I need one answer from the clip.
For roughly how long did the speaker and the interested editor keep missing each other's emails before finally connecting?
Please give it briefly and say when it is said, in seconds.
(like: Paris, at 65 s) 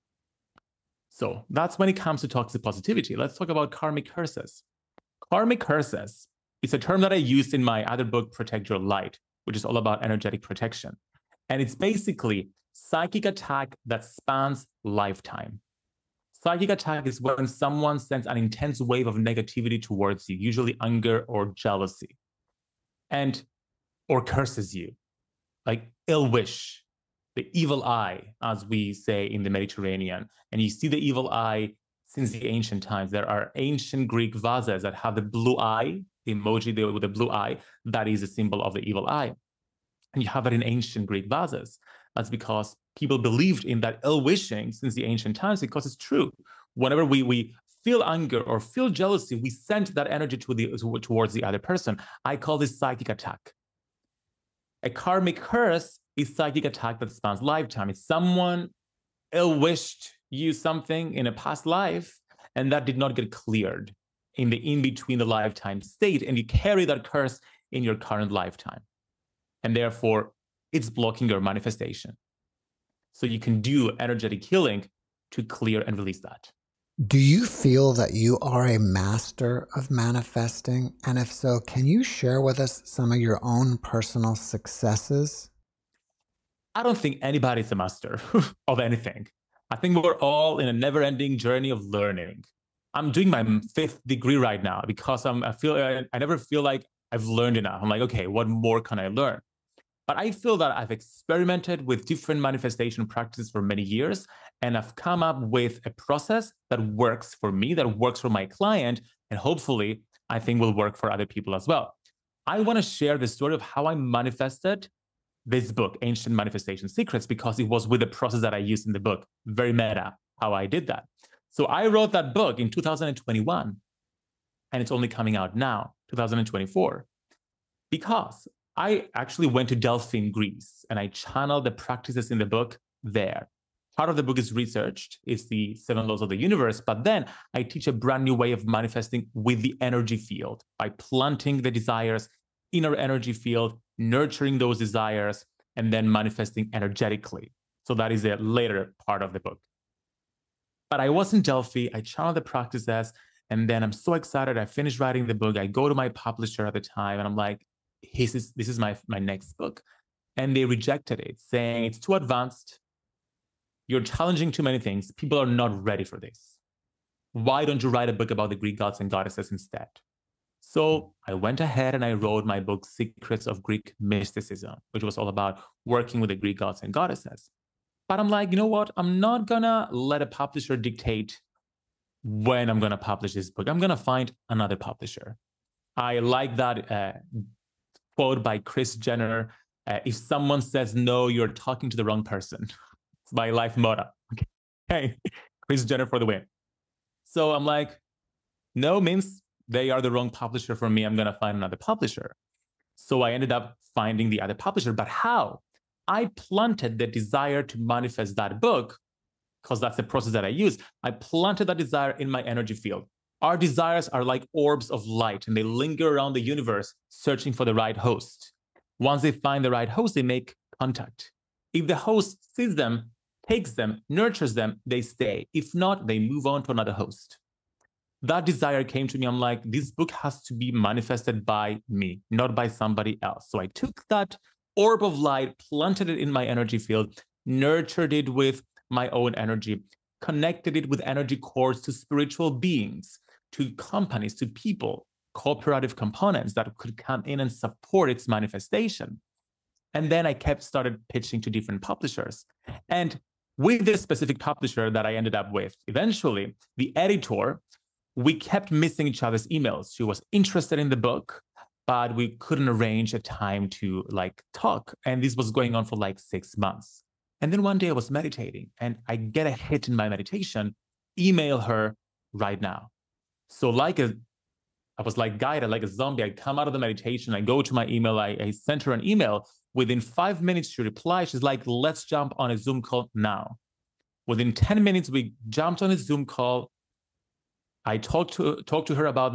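6 months, at 266 s.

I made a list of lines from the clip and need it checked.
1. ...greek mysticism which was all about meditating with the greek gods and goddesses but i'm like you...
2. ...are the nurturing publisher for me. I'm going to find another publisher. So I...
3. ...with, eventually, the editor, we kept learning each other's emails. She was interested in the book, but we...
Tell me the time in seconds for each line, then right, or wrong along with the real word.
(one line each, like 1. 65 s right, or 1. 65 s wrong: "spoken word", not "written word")
1. 173 s wrong: "working", not "meditating"
2. 199 s wrong: "wrong", not "nurturing"
3. 255 s wrong: "missing", not "learning".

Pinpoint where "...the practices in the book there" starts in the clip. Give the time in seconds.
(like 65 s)
131 s.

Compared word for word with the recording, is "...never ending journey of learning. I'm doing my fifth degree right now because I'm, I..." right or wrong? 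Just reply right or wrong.
right.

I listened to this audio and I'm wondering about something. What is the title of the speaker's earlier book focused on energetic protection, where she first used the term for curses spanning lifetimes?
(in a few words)
Protect Your Light.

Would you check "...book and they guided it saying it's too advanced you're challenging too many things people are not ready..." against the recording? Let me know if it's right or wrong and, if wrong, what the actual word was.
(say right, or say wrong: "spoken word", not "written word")
wrong: "rejected", not "guided".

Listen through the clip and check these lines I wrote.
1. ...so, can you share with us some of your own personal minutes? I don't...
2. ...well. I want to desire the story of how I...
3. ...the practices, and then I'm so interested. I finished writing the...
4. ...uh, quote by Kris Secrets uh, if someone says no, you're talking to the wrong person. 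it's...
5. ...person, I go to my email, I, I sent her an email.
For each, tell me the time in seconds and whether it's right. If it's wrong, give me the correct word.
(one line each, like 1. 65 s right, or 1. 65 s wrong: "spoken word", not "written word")
1. 81 s wrong: "successes", not "minutes"
2. 111 s wrong: "share", not "desire"
3. 152 s wrong: "excited", not "interested"
4. 186 s wrong: "Jenner", not "Secrets"
5. 276 s wrong: "meditation", not "person".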